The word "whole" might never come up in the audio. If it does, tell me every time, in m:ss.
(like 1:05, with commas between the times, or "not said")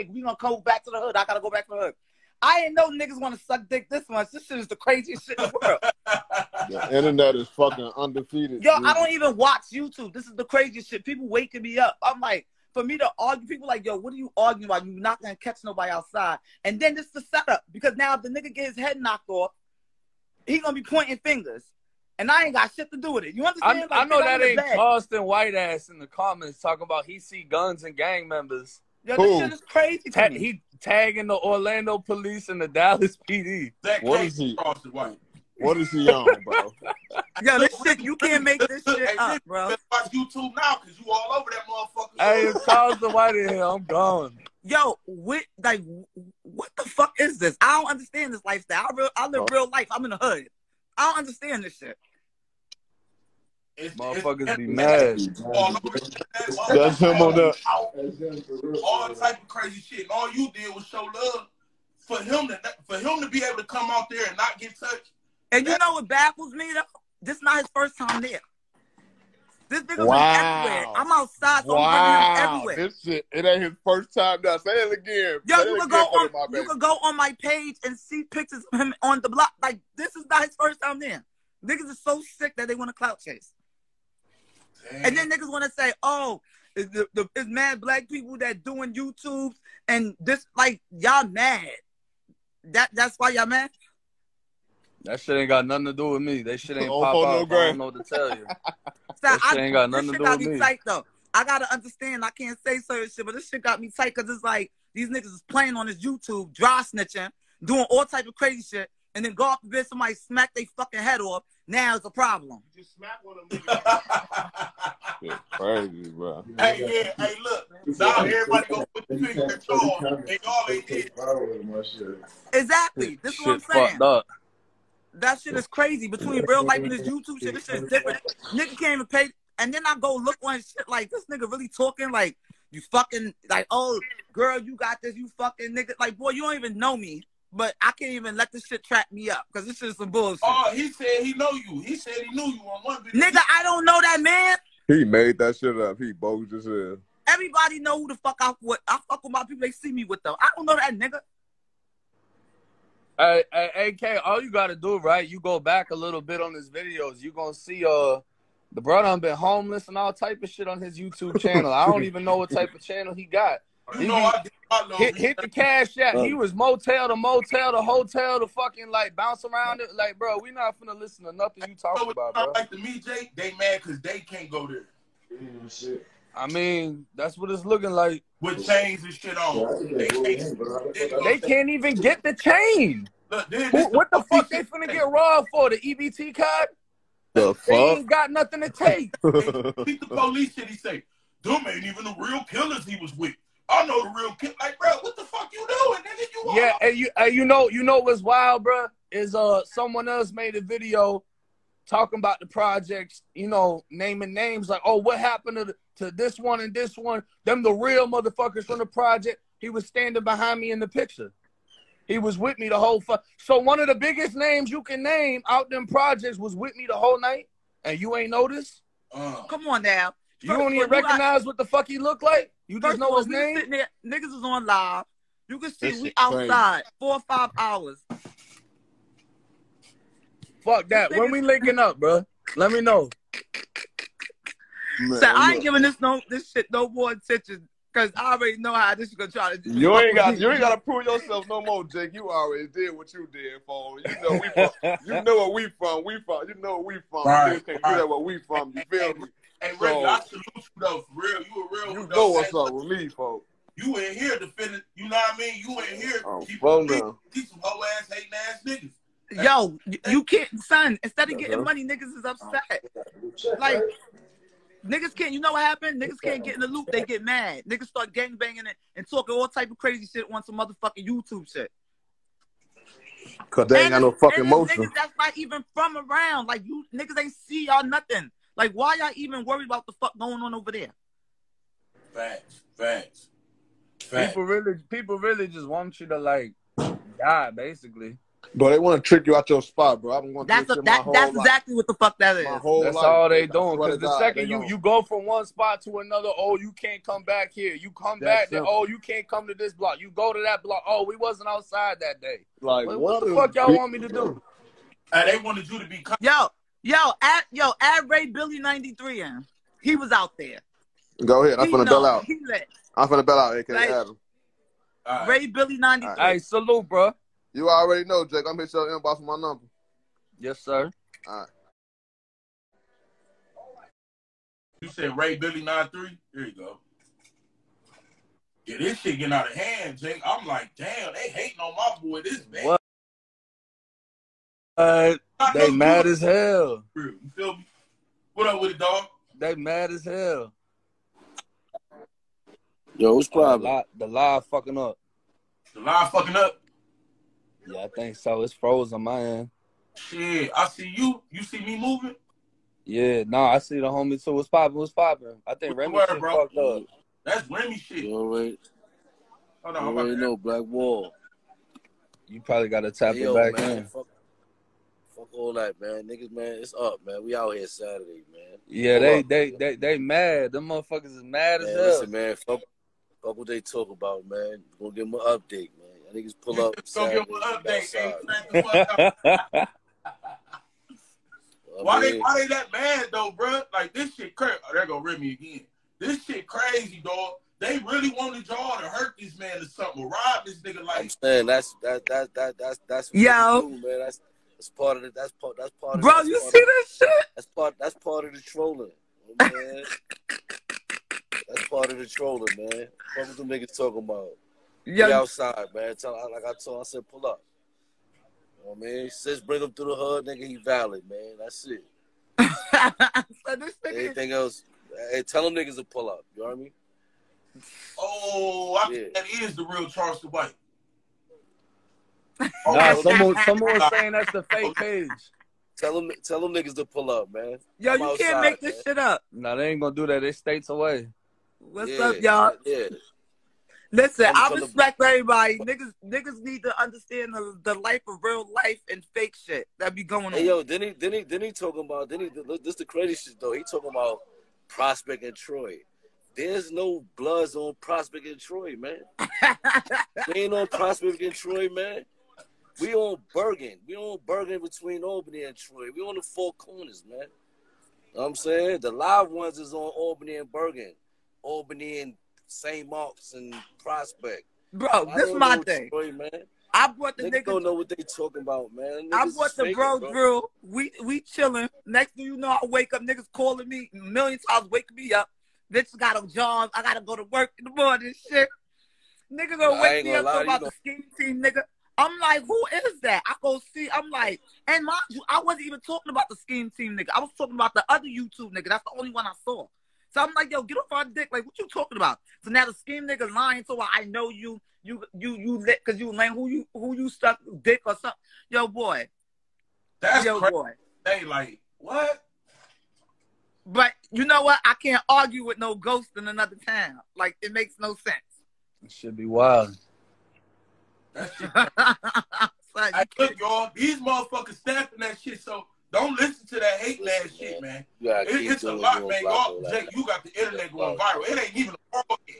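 3:32, 3:36.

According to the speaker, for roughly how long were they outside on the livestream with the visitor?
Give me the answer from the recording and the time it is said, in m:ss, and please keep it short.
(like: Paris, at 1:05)
4 or 5 hours, at 3:46.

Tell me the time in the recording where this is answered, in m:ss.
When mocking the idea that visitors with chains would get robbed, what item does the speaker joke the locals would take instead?
3:05.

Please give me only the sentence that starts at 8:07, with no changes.
I was talking about the other YouTube nigga.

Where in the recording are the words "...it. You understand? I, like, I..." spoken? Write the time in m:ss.
0:23.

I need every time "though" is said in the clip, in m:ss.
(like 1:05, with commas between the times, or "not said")
1:06, 1:40, 4:10, 6:23, 7:23.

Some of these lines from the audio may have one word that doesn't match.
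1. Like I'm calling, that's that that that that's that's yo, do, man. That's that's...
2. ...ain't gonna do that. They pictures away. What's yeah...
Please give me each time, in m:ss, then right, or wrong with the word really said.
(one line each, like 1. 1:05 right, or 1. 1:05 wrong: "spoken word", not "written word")
1. 6:30 wrong: "saying", not "calling"
2. 7:09 wrong: "states", not "pictures".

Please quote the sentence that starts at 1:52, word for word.
You just smack one of them.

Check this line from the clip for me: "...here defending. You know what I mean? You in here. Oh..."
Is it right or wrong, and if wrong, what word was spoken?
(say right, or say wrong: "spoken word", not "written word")
right.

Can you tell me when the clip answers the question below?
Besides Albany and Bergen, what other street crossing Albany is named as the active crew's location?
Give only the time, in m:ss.
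7:42.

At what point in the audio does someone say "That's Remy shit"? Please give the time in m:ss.
5:57.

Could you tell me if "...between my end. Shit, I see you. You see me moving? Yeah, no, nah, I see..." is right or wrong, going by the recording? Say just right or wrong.
wrong.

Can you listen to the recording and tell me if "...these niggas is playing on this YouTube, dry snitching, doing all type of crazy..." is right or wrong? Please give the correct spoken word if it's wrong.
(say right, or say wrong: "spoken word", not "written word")
right.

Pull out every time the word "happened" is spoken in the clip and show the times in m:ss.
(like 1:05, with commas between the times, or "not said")
3:25, 4:25.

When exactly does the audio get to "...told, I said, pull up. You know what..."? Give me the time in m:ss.
6:46.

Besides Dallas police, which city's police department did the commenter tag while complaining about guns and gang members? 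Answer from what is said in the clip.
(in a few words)
Orlando.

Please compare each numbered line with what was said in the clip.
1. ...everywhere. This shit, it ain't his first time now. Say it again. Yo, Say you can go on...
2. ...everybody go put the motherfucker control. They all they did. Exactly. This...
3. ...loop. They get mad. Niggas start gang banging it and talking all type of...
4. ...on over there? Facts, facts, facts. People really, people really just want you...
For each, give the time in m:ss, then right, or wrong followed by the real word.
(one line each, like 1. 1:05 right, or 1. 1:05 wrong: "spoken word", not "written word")
1. 1:12 right
2. 1:58 wrong: "finger", not "motherfucker"
3. 4:26 right
4. 4:40 right.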